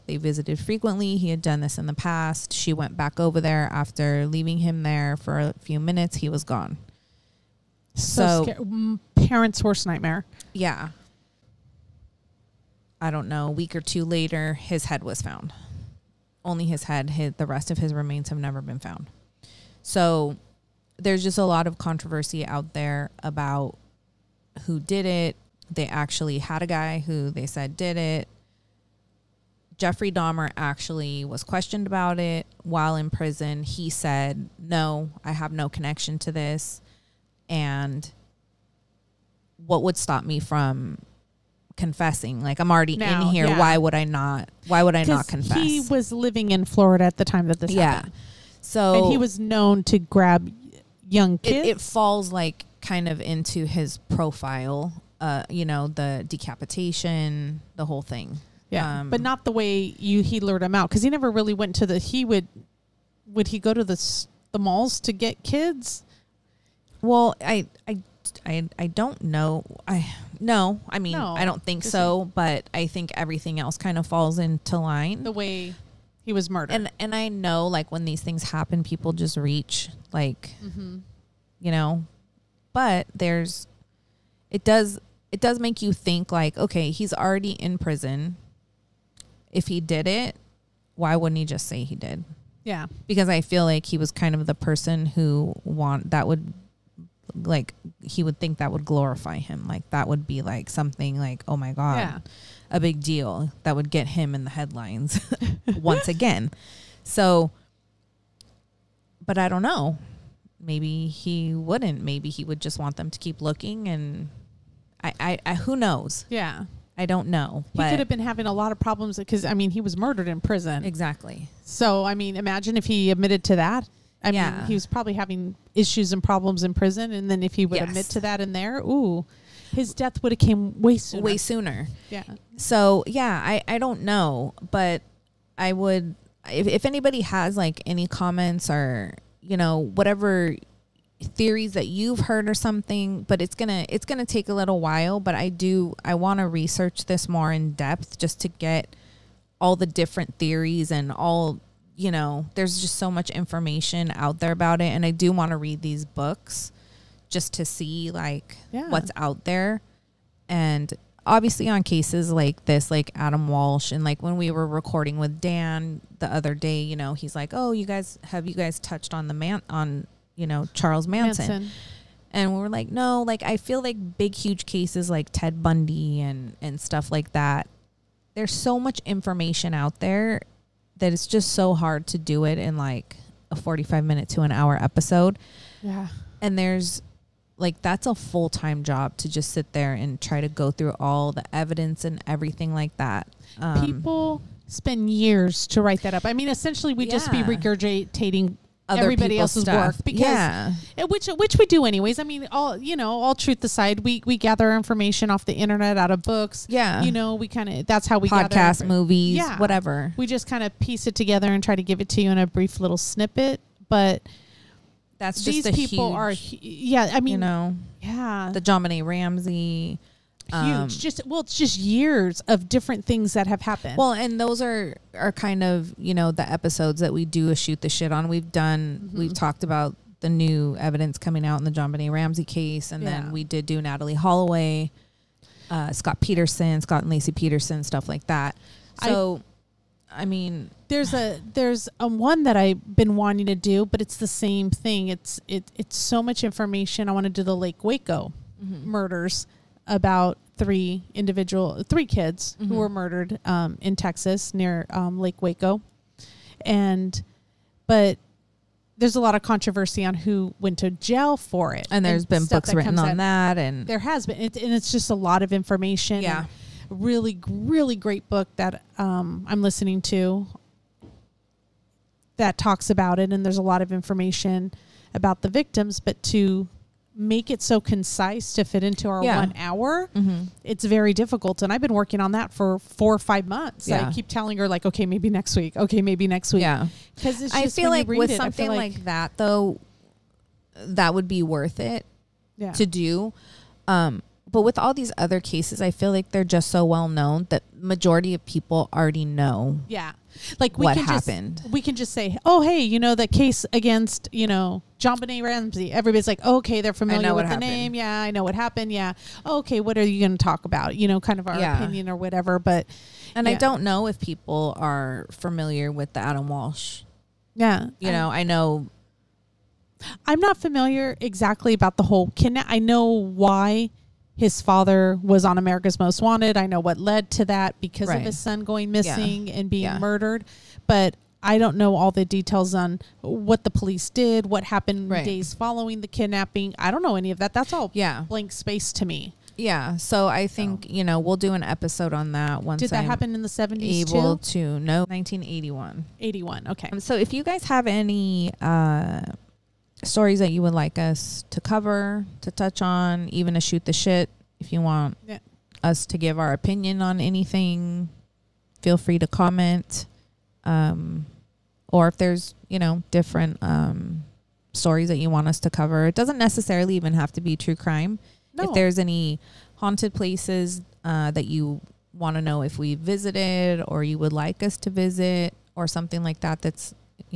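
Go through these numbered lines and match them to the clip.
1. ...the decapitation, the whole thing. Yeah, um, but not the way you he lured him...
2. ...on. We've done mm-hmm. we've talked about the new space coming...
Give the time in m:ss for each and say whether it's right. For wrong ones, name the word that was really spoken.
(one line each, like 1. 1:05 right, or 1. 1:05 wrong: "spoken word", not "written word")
1. 0:55 right
2. 3:48 wrong: "evidence", not "space".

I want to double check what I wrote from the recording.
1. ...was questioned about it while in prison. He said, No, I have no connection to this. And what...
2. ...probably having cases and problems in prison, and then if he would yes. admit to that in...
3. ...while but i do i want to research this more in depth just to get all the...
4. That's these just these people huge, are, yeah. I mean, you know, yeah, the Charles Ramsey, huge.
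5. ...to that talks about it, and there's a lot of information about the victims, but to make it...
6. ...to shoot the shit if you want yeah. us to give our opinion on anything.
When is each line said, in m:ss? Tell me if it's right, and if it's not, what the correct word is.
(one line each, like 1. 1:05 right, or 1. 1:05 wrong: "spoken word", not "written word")
1. 0:31 right
2. 2:04 wrong: "issues", not "cases"
3. 2:24 right
4. 3:35 wrong: "JonBenét", not "Charles"
5. 4:30 right
6. 5:53 right.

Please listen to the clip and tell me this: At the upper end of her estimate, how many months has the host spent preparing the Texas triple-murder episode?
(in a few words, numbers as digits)
5 months.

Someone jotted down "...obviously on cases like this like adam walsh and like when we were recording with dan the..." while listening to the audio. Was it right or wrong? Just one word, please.
right.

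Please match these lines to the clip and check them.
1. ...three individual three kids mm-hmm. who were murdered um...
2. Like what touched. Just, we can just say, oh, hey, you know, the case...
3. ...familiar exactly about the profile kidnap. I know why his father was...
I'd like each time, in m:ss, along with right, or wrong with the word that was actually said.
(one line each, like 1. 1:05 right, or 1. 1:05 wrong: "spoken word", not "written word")
1. 4:10 right
2. 5:00 wrong: "happened", not "touched"
3. 5:20 wrong: "whole", not "profile".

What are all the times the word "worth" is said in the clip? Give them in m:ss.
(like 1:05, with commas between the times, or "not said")
4:51.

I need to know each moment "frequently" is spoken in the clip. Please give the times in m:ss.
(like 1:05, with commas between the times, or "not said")
0:00.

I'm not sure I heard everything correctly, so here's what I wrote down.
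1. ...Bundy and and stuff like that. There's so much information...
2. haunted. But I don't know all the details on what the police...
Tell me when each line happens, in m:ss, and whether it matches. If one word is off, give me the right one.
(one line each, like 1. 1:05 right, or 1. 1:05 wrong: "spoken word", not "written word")
1. 2:55 right
2. 5:29 wrong: "murdered", not "haunted".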